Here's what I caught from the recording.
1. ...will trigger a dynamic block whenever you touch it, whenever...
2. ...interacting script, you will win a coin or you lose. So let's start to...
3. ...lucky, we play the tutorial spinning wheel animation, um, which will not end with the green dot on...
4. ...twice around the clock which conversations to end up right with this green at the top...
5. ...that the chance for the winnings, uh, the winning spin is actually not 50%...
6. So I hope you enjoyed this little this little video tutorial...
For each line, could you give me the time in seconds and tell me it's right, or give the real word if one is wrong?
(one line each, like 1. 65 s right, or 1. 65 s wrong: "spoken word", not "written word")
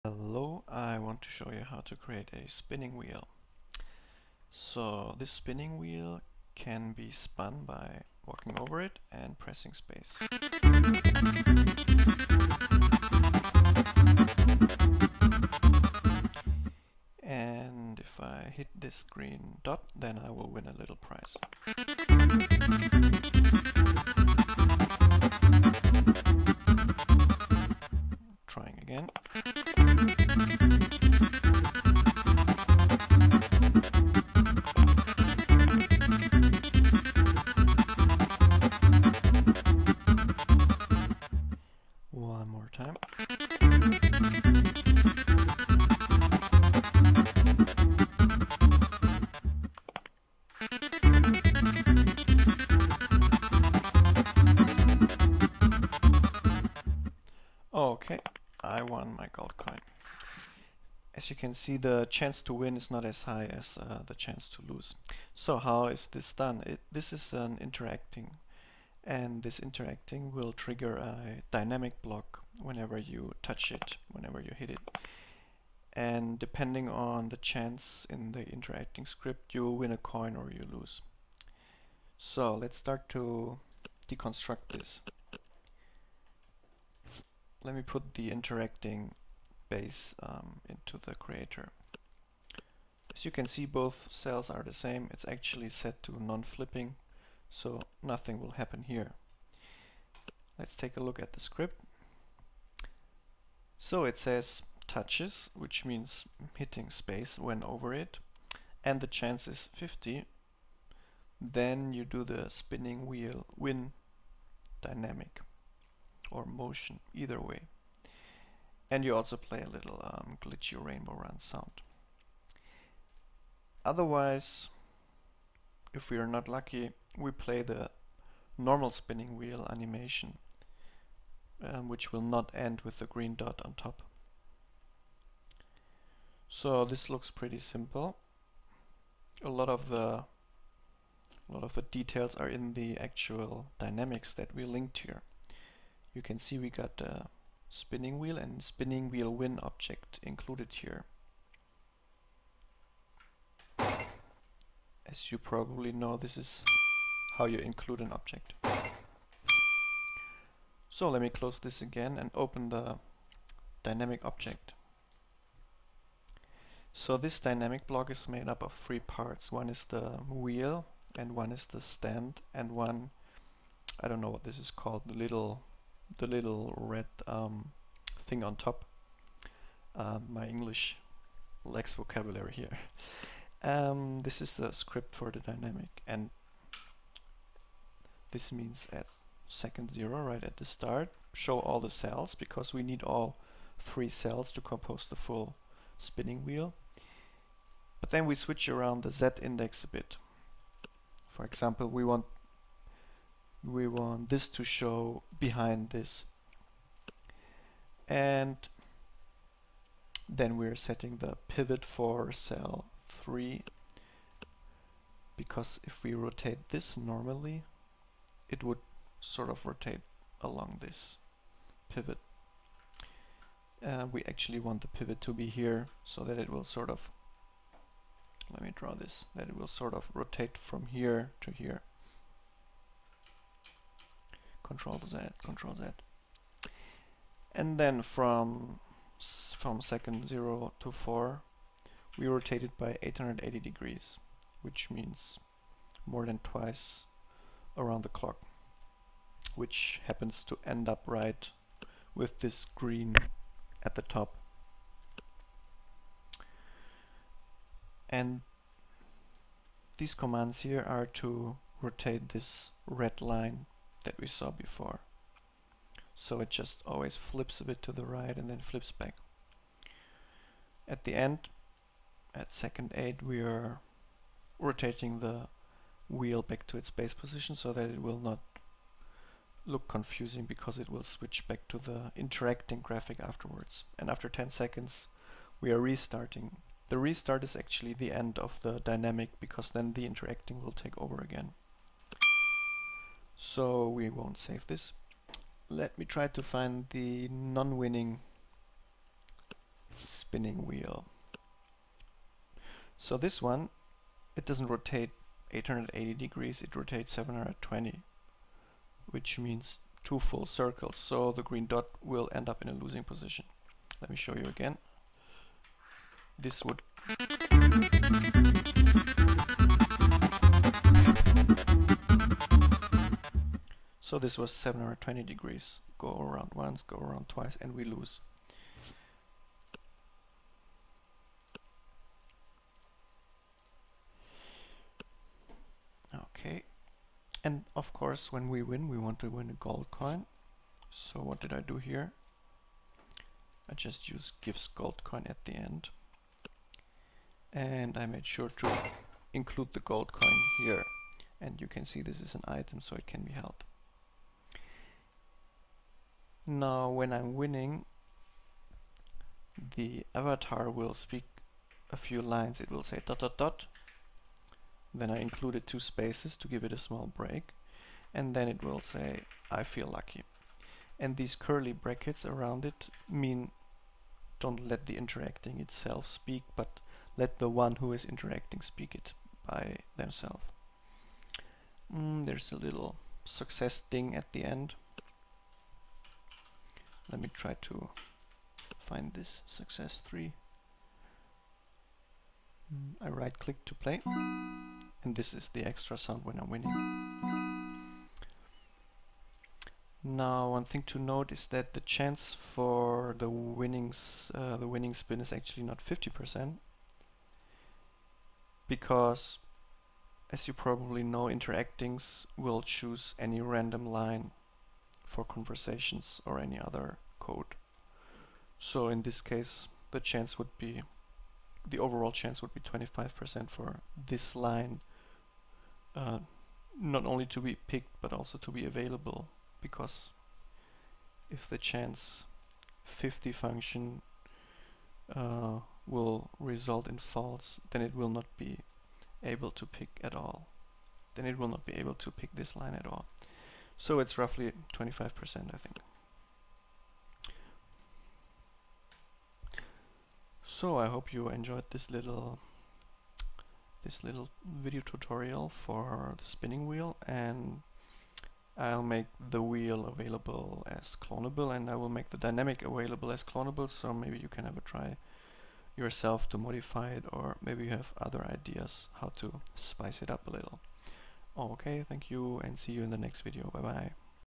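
1. 70 s right
2. 78 s right
3. 126 s wrong: "normal", not "tutorial"
4. 246 s wrong: "happens", not "conversations"
5. 401 s right
6. 450 s right.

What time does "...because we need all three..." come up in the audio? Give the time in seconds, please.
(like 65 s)
192 s.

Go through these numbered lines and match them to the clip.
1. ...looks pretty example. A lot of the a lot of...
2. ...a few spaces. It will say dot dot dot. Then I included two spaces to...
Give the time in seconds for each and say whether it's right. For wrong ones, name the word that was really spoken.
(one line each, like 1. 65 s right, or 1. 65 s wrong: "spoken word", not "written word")
1. 137 s wrong: "simple", not "example"
2. 361 s wrong: "lines", not "spaces".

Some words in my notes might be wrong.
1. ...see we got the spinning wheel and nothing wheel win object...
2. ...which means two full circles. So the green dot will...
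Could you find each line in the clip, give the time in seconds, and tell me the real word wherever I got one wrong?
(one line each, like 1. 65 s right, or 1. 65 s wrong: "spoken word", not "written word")
1. 146 s wrong: "spinning", not "nothing"
2. 309 s right.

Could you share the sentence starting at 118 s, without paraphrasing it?
And you also play a little um, glitchy rainbow run sound.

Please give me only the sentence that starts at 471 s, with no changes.
Oh, okay, thank you and see you in the next video.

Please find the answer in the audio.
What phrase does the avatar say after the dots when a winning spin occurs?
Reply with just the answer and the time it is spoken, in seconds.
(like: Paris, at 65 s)
I feel lucky, at 369 s.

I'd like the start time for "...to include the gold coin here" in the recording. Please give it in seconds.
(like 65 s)
348 s.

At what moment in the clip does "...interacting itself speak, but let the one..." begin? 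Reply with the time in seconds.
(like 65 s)
374 s.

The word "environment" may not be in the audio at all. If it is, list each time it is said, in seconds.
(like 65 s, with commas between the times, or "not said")
not said.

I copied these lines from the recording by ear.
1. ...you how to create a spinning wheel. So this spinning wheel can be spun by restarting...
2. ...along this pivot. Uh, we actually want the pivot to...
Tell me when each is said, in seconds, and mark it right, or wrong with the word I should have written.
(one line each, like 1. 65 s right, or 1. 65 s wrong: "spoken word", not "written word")
1. 1 s wrong: "walking", not "restarting"
2. 220 s right.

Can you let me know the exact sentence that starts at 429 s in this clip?
Because if the chance 50 function uh, will result in false, then it will not be able to pick at all.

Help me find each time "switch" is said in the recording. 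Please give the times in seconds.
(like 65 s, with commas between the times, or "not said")
198 s, 281 s.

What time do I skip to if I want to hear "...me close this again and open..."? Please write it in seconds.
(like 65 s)
161 s.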